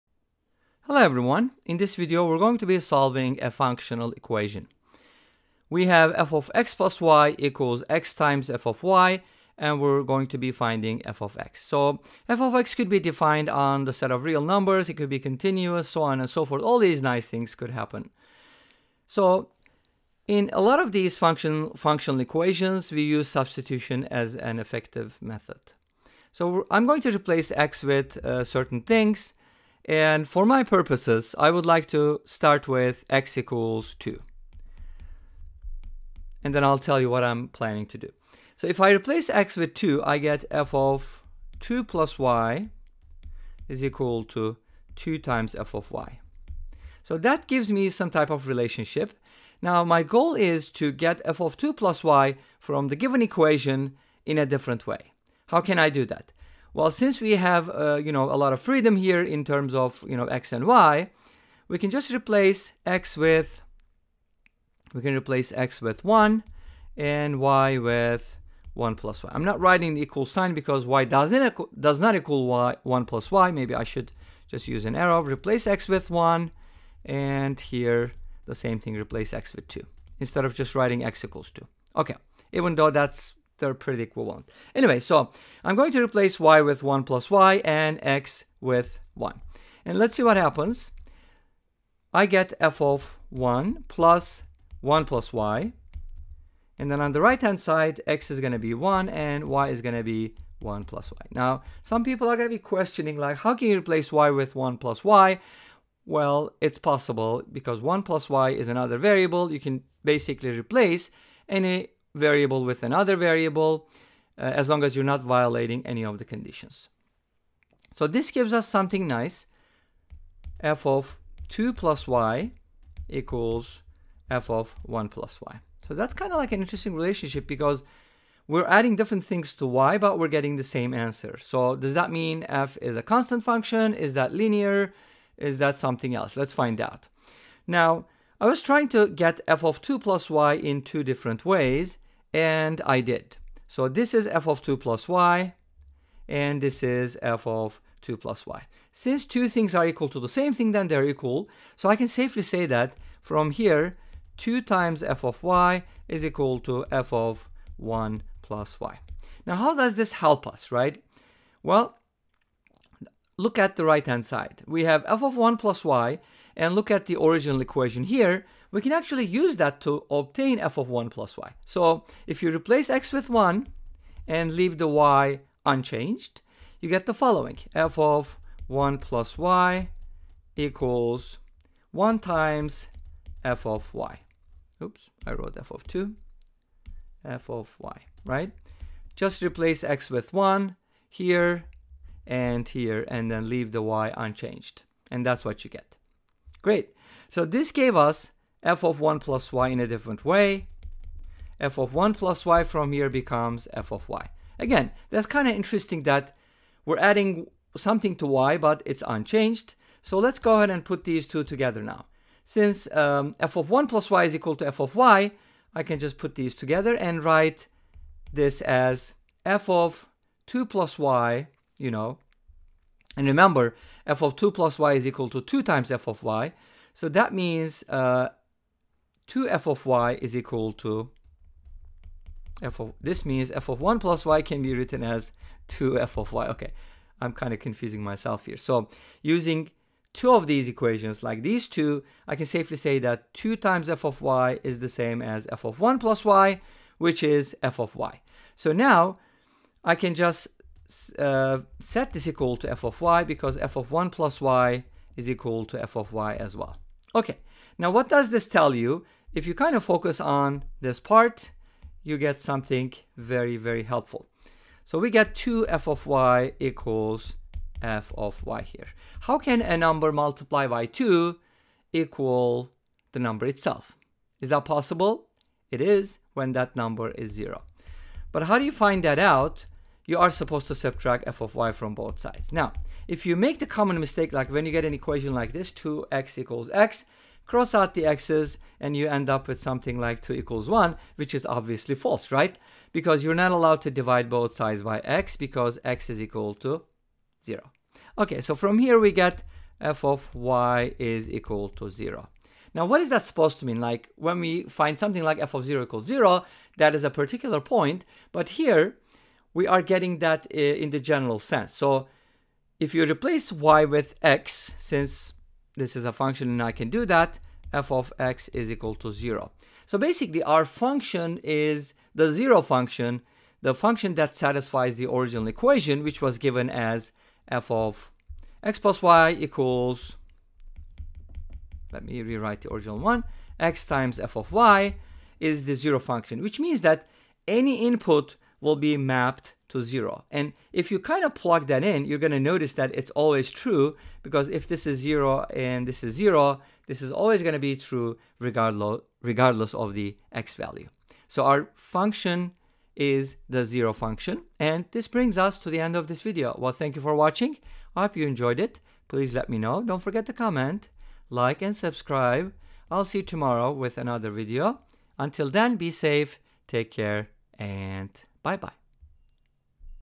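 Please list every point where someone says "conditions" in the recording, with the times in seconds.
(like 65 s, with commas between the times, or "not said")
116 s.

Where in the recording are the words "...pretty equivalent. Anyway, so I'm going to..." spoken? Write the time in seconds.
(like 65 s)
83 s.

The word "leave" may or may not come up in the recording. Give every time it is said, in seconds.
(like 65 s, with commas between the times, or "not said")
174 s, 193 s.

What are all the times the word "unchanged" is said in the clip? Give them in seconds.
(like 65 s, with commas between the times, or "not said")
175 s, 194 s, 209 s.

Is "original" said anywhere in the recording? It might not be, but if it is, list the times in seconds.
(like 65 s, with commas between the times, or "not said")
167 s, 325 s, 332 s.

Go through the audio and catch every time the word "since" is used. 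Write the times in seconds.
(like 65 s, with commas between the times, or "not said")
56 s, 148 s, 212 s, 314 s.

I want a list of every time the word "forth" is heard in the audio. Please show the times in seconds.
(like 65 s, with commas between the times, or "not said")
16 s.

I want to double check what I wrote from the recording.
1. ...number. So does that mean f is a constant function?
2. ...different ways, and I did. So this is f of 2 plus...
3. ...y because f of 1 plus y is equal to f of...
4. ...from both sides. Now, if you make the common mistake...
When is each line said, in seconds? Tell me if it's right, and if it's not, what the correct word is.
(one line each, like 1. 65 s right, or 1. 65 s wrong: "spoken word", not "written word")
1. 130 s wrong: "answer", not "number"
2. 141 s right
3. 252 s right
4. 281 s right.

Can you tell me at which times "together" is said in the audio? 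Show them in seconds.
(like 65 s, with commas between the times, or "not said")
211 s, 216 s.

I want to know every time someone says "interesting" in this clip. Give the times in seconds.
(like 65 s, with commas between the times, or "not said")
126 s, 205 s.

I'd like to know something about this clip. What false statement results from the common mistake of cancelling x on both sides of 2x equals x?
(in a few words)
2 equals 1.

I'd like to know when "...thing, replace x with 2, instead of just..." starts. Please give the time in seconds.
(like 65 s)
78 s.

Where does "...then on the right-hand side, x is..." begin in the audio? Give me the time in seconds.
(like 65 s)
96 s.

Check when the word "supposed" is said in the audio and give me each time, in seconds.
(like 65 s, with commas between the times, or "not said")
280 s, 303 s.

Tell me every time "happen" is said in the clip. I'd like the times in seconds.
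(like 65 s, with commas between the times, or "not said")
17 s, 90 s.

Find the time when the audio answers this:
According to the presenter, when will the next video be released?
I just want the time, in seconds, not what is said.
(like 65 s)
363 s.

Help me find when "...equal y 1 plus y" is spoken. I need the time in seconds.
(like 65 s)
72 s.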